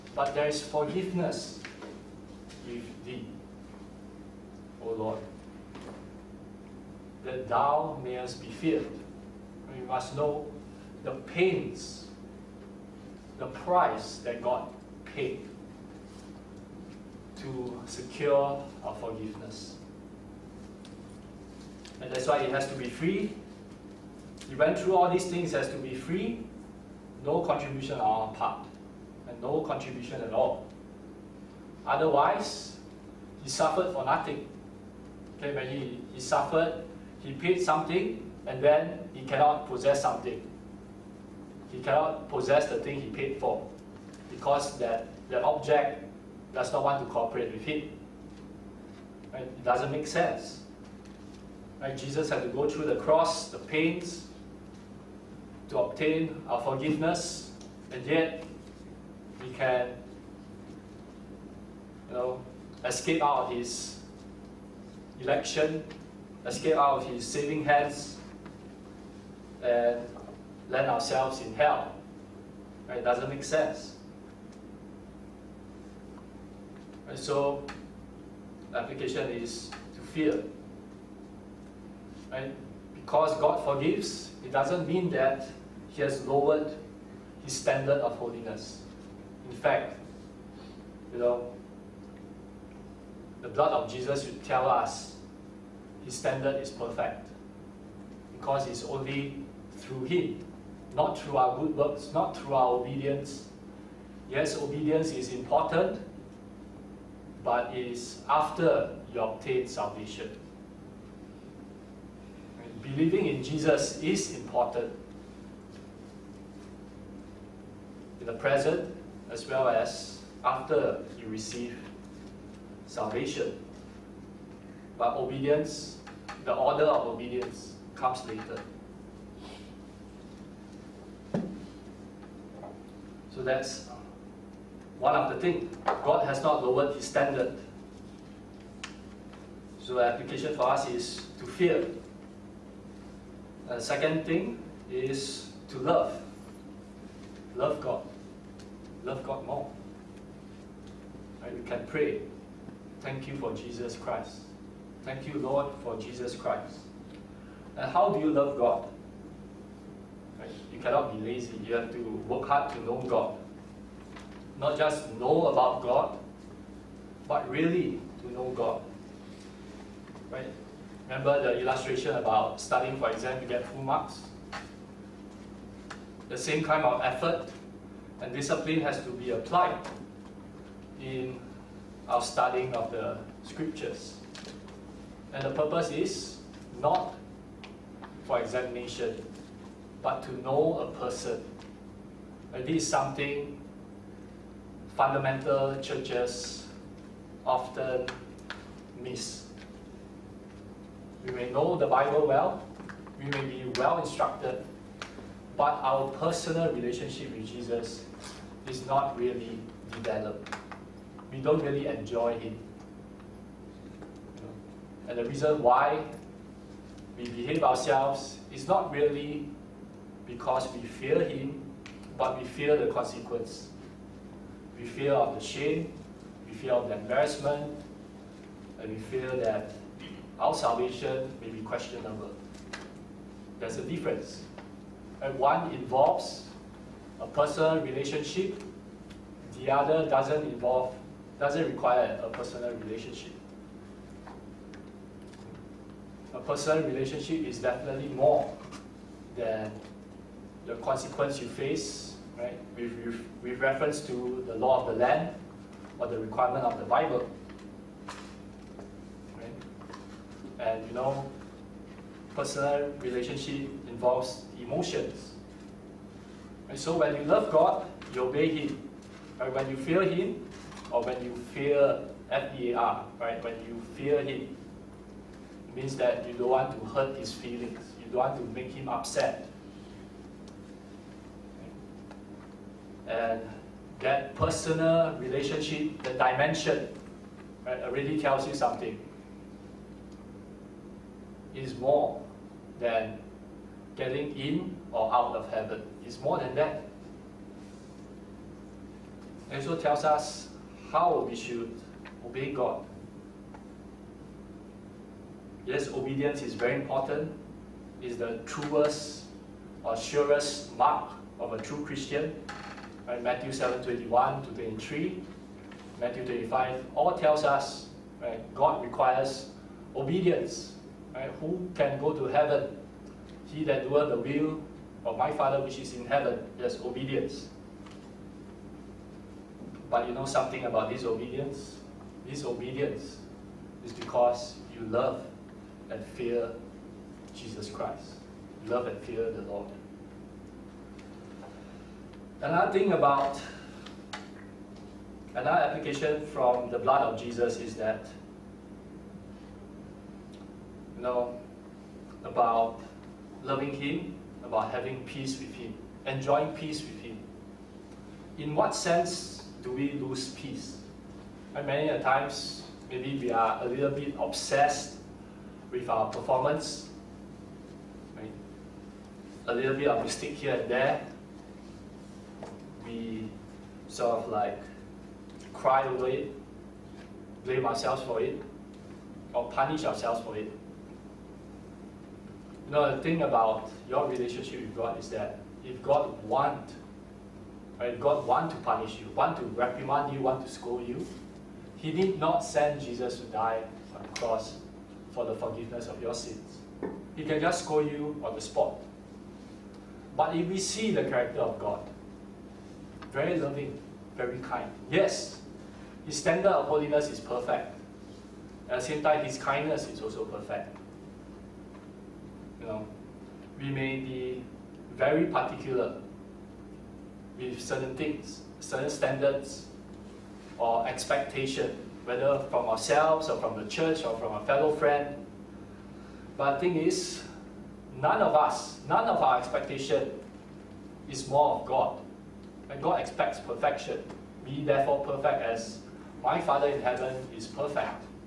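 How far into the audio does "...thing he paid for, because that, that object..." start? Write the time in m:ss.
0:42.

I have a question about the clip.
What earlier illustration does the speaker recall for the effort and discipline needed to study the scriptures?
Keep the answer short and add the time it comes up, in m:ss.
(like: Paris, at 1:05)
Studying for exam, at 2:52.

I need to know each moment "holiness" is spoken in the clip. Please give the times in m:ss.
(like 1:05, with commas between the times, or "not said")
1:28, 6:46.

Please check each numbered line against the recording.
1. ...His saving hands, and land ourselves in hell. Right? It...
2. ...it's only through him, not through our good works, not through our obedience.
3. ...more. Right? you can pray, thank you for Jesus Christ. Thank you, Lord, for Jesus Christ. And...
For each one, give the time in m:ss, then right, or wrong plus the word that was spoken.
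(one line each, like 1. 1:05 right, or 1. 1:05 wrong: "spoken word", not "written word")
1. 1:07 right
2. 1:38 right
3. 2:29 right.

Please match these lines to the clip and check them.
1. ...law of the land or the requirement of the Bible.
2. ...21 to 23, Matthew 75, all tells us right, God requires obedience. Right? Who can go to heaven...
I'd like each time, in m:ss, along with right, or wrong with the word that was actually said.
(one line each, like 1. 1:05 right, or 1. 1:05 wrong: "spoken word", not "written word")
1. 4:14 right
2. 5:13 wrong: "25", not "75".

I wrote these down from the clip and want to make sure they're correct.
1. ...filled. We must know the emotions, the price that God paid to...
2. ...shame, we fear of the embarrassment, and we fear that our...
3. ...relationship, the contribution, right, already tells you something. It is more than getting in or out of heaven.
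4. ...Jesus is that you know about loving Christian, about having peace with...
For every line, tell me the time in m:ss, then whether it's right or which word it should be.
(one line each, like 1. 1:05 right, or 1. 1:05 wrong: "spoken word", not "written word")
1. 0:08 wrong: "pains", not "emotions"
2. 3:45 right
3. 4:45 wrong: "dimension", not "contribution"
4. 5:47 wrong: "Him", not "Christian".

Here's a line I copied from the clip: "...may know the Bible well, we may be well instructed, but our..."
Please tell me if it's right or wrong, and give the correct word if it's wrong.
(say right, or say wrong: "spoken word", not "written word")
right.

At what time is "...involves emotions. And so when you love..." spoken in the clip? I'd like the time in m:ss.
4:23.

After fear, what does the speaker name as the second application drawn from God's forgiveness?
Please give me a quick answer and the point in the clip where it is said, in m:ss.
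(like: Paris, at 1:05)
To love, at 2:25.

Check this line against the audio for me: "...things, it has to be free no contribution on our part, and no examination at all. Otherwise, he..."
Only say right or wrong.
wrong.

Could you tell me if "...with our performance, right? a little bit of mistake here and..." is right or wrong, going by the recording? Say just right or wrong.
right.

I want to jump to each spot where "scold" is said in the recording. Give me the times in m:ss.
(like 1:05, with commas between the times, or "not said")
6:30, 6:37.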